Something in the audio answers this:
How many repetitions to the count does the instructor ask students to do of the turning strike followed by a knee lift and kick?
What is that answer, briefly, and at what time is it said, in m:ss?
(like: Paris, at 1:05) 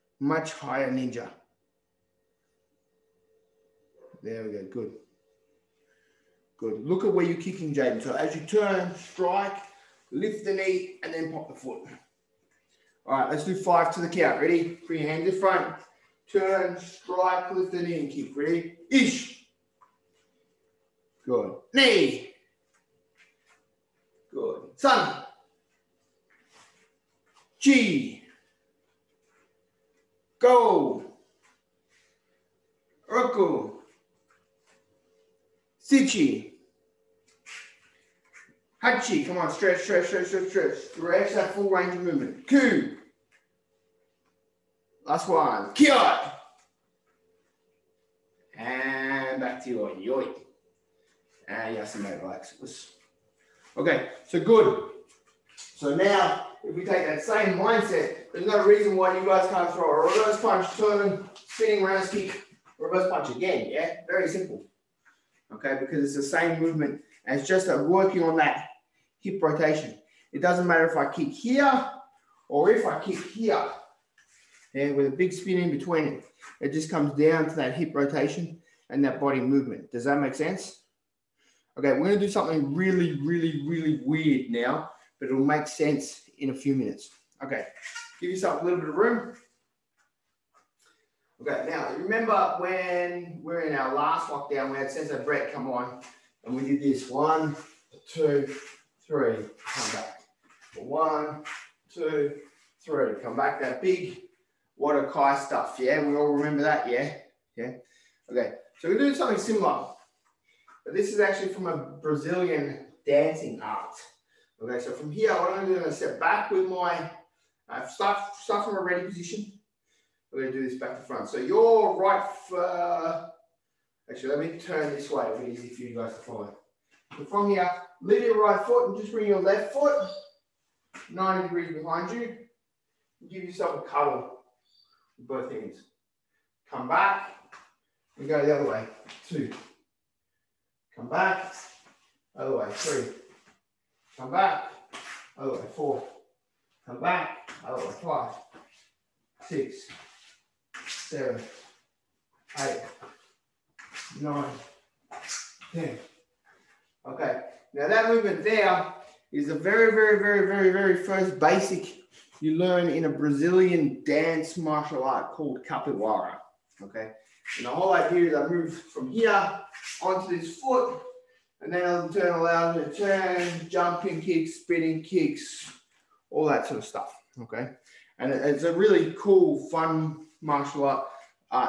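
5, at 0:13.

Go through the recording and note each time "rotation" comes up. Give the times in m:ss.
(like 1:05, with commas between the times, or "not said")
1:09, 1:17.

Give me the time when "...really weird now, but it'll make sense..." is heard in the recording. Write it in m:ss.
1:23.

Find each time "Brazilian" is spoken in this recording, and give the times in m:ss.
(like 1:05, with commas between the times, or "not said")
1:52, 2:43.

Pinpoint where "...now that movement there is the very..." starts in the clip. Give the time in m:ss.
2:37.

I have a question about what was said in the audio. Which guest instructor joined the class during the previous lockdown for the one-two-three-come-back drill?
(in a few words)
Sensei Brett.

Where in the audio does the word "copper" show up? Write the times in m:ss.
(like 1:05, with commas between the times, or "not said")
not said.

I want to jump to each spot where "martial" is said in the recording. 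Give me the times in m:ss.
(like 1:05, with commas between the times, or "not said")
2:44, 3:00.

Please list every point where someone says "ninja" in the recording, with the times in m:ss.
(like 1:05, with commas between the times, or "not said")
0:00.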